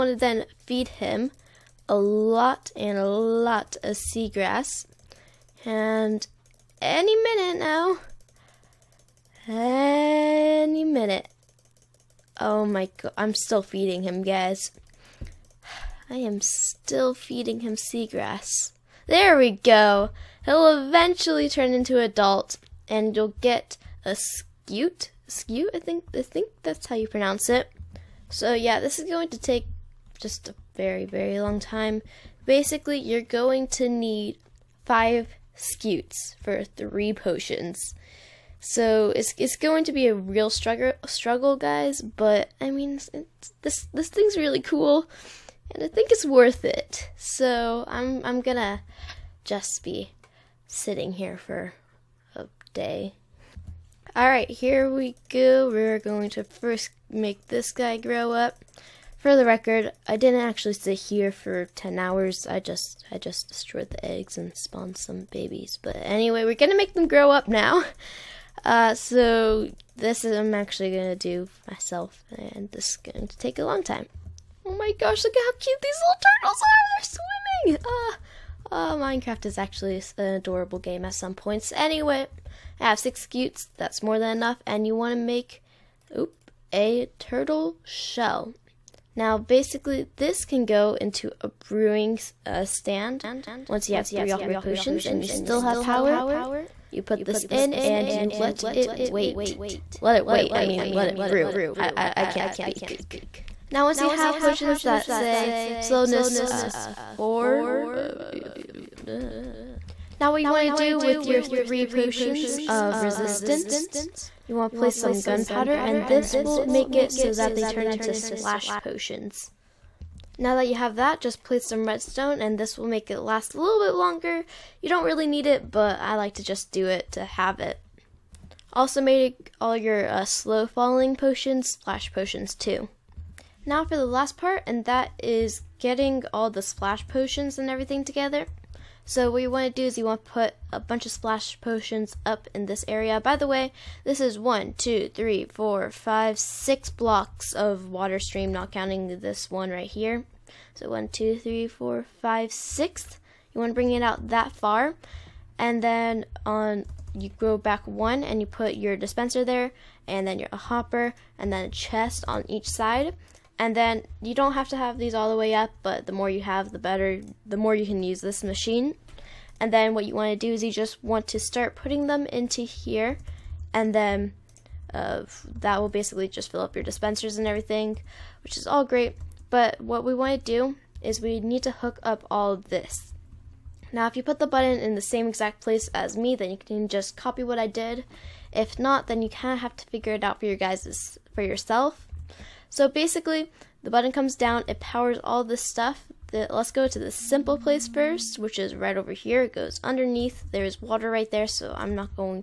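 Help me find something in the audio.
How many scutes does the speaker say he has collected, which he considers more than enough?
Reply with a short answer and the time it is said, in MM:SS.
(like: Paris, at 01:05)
6, at 01:22.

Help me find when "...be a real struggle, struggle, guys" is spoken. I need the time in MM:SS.
00:39.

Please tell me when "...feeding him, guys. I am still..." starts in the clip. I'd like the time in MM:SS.
00:13.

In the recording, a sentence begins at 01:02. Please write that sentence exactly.
I just I just destroyed the eggs and spawned some babies.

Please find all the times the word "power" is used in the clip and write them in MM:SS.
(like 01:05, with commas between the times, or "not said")
01:35, 03:14.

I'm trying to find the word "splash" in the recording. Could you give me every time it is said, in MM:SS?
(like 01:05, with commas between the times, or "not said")
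01:58, 02:11, 02:16, 02:21.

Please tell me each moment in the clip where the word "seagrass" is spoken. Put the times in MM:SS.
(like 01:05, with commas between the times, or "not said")
00:03, 00:17.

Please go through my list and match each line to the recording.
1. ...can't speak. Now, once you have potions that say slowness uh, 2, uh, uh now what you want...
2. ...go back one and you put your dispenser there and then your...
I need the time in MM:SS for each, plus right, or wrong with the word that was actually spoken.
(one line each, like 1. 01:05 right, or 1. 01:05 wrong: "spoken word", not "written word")
1. 01:42 wrong: "4", not "2"
2. 02:37 right.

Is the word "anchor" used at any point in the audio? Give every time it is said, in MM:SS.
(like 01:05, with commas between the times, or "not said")
not said.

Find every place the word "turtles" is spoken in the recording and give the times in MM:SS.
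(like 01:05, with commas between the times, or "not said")
01:17, 01:27.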